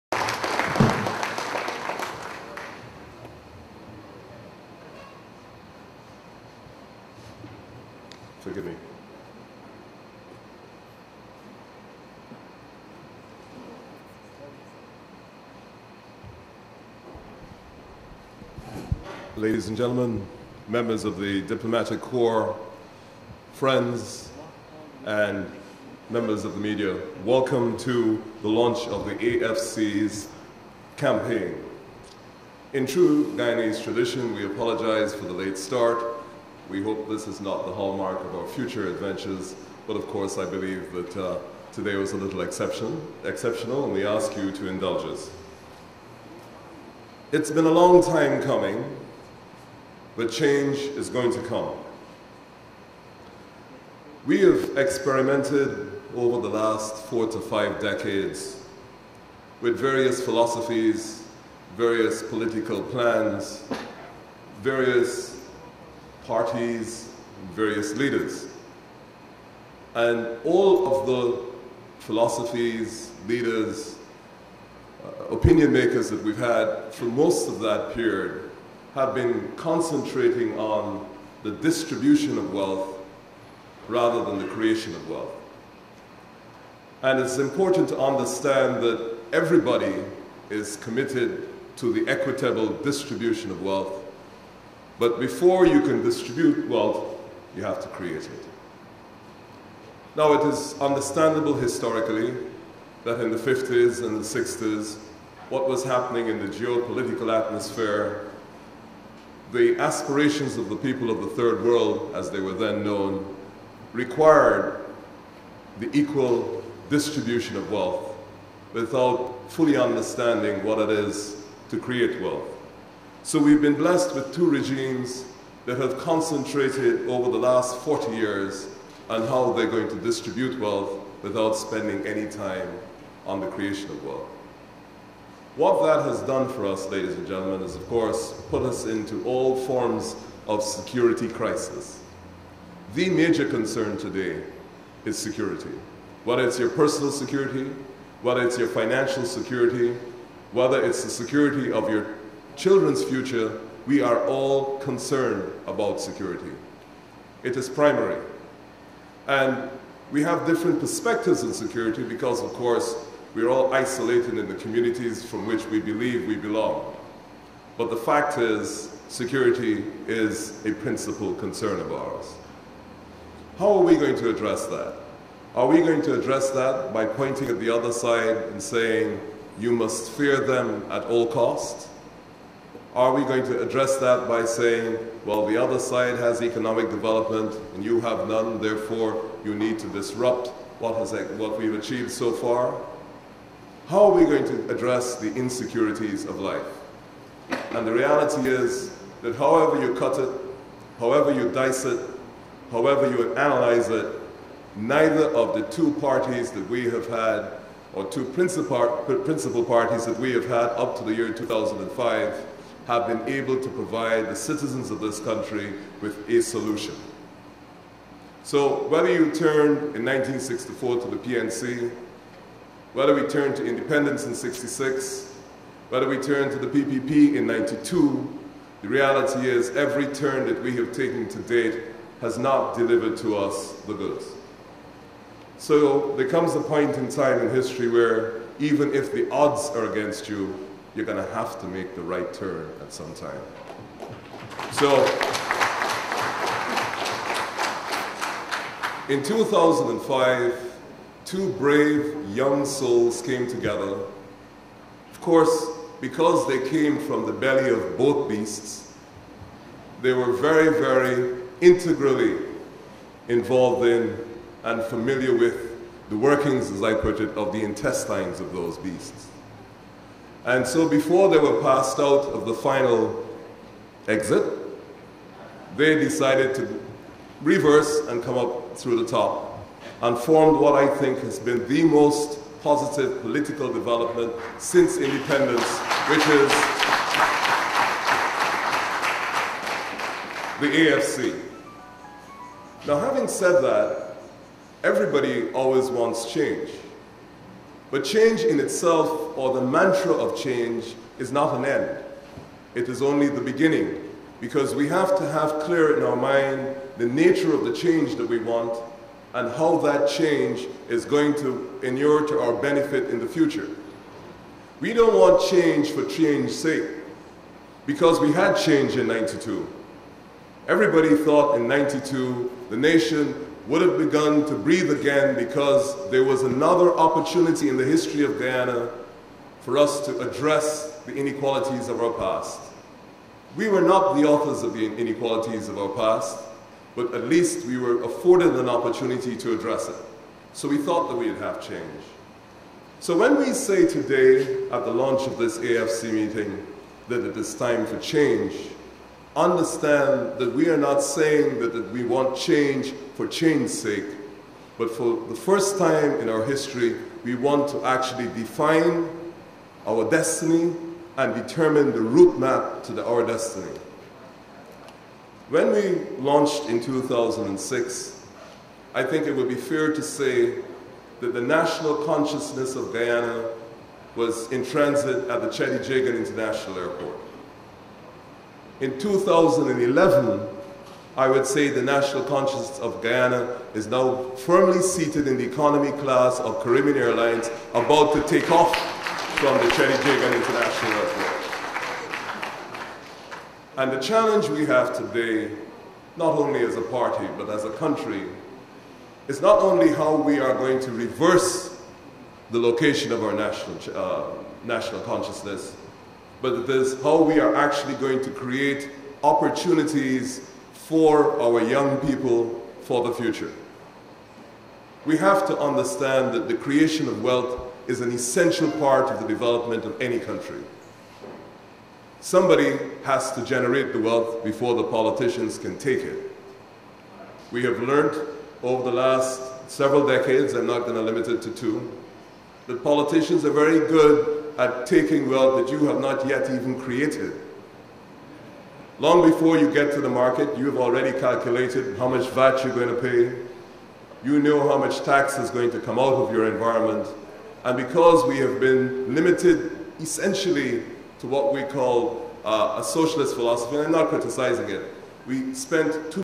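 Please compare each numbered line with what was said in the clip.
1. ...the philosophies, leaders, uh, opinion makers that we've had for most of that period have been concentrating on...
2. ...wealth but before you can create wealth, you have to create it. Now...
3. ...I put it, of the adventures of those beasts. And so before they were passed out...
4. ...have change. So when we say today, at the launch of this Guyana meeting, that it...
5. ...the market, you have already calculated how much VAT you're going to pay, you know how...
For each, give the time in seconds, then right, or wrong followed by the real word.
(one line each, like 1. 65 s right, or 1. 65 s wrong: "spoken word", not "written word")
1. 71 s right
2. 93 s wrong: "distribute", not "create"
3. 266 s wrong: "intestines", not "adventures"
4. 341 s wrong: "AFC", not "Guyana"
5. 440 s right.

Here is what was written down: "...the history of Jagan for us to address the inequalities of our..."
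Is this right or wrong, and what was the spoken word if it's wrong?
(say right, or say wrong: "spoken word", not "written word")
wrong: "Guyana", not "Jagan".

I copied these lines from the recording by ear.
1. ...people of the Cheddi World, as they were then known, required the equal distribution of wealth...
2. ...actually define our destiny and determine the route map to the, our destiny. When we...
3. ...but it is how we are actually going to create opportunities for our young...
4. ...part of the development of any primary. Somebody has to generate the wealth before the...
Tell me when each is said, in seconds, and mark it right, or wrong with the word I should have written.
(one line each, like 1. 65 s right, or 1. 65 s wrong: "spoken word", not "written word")
1. 110 s wrong: "Third", not "Cheddi"
2. 357 s right
3. 406 s right
4. 418 s wrong: "country", not "primary".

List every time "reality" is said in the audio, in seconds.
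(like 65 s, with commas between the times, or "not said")
197 s, 228 s.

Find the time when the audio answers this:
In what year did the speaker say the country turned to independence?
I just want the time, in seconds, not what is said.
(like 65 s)
224 s.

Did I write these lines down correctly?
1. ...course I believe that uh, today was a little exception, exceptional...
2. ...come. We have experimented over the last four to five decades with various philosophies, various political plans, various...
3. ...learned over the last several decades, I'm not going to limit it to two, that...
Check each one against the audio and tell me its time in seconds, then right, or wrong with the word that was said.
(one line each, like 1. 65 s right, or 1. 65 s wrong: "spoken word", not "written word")
1. 40 s right
2. 51 s right
3. 427 s right.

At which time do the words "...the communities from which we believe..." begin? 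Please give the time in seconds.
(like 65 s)
164 s.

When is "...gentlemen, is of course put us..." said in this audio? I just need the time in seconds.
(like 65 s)
137 s.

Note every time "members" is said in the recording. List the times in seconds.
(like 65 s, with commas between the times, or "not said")
20 s, 26 s.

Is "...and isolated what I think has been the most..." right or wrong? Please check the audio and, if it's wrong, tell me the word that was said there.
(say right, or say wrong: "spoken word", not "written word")
wrong: "formed", not "isolated".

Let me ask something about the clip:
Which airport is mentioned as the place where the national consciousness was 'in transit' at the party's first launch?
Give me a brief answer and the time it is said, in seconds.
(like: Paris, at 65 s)
Cheddi Jagan International Airport, at 375 s.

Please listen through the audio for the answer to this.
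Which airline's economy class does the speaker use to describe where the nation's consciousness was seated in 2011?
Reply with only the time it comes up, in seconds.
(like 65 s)
386 s.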